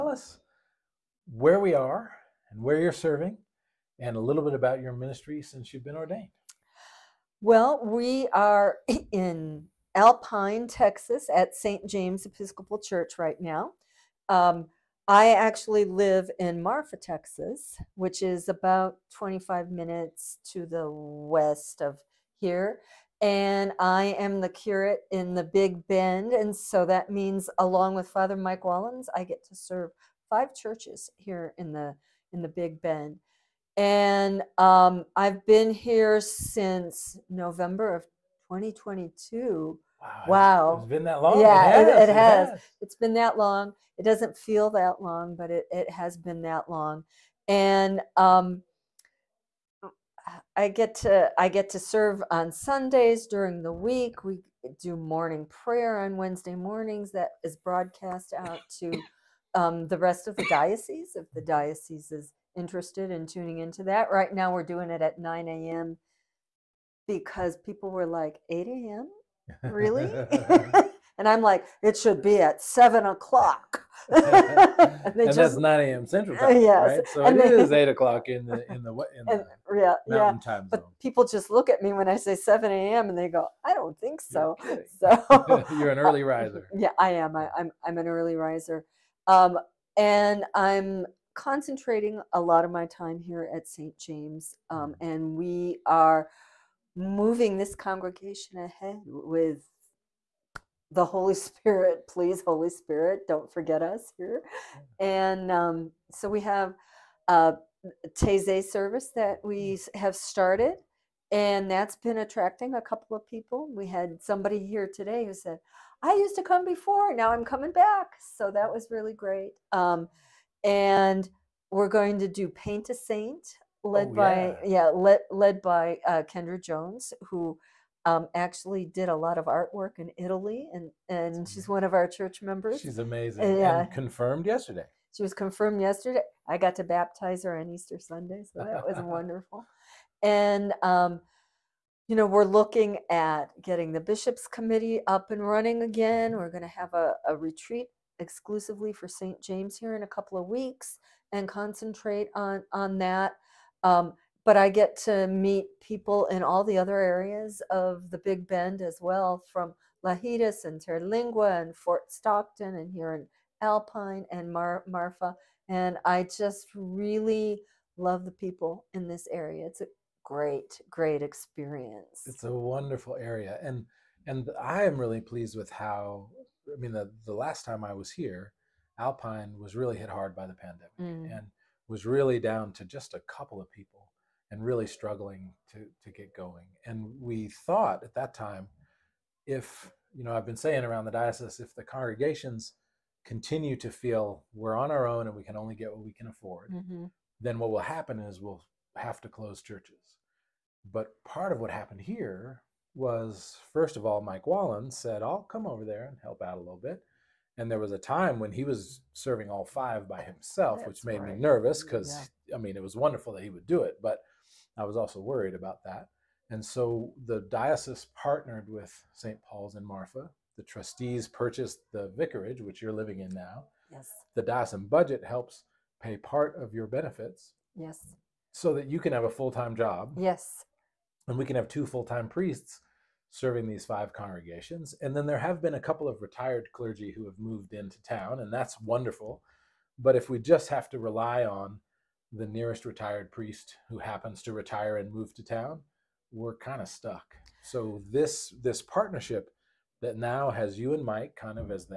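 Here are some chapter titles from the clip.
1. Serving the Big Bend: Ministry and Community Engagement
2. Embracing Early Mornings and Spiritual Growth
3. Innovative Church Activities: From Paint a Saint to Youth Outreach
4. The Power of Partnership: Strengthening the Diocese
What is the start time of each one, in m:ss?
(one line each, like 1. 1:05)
1. 0:07
2. 0:47
3. 1:44
4. 3:20.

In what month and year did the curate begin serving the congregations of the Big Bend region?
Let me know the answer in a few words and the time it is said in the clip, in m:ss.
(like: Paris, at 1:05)
November 2022, at 0:37.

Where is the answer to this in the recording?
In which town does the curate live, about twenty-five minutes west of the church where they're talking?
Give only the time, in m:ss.
0:16.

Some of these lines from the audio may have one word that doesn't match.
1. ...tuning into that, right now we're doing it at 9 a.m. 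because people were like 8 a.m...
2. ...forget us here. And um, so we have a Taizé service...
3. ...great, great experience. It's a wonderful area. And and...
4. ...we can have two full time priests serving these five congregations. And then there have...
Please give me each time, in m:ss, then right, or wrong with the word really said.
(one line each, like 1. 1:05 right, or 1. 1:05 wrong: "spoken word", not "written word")
1. 1:03 right
2. 1:43 right
3. 2:50 right
4. 3:51 right.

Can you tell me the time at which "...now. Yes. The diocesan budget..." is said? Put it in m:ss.
3:43.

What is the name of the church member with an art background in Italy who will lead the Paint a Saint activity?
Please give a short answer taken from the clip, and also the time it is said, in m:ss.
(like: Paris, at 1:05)
Kendra Jones, at 2:06.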